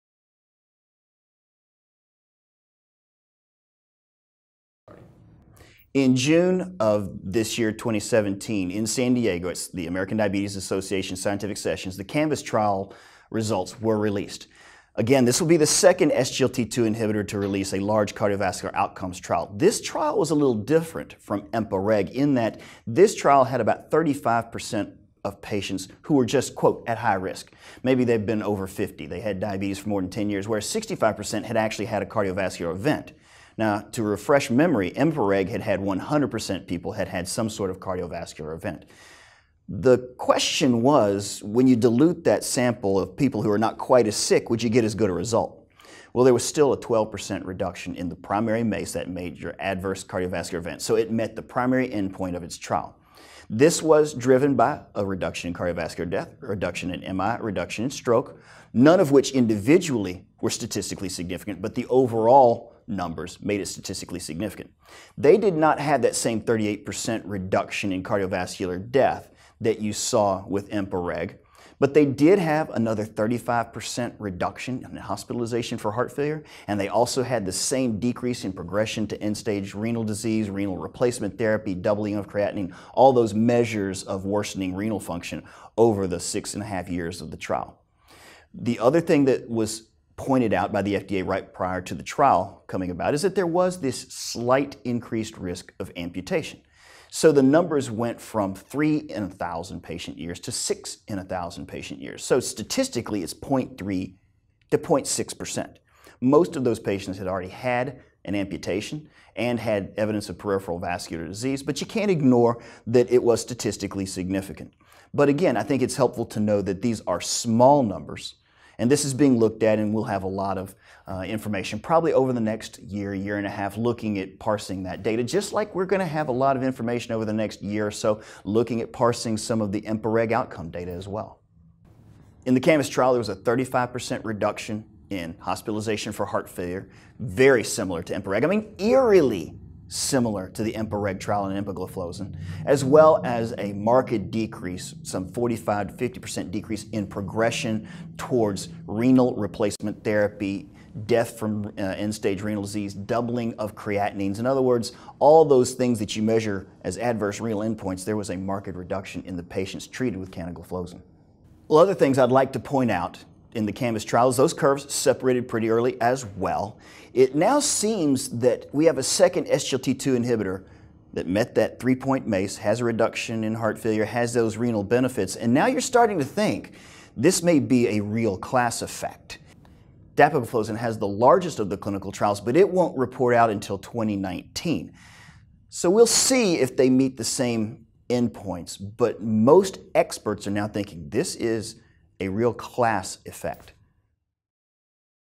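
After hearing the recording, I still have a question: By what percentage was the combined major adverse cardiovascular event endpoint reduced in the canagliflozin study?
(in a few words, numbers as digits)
12%.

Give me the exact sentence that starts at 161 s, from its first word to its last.
Well, other things I'd like to point out in the Canvas trials, those curves separated pretty early as well.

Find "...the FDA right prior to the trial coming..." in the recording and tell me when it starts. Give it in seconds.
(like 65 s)
90 s.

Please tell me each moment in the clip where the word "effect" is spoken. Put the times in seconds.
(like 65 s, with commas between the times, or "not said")
178 s, 193 s.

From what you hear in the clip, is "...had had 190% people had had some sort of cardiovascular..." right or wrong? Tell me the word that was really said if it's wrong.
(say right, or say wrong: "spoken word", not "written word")
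wrong: "100", not "190".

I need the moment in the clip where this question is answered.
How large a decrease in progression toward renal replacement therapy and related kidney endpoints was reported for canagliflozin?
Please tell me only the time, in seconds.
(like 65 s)
145 s.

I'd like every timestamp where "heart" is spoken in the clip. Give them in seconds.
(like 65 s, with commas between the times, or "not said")
75 s, 136 s, 173 s.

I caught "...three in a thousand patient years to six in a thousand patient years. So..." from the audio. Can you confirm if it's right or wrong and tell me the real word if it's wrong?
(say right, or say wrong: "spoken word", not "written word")
right.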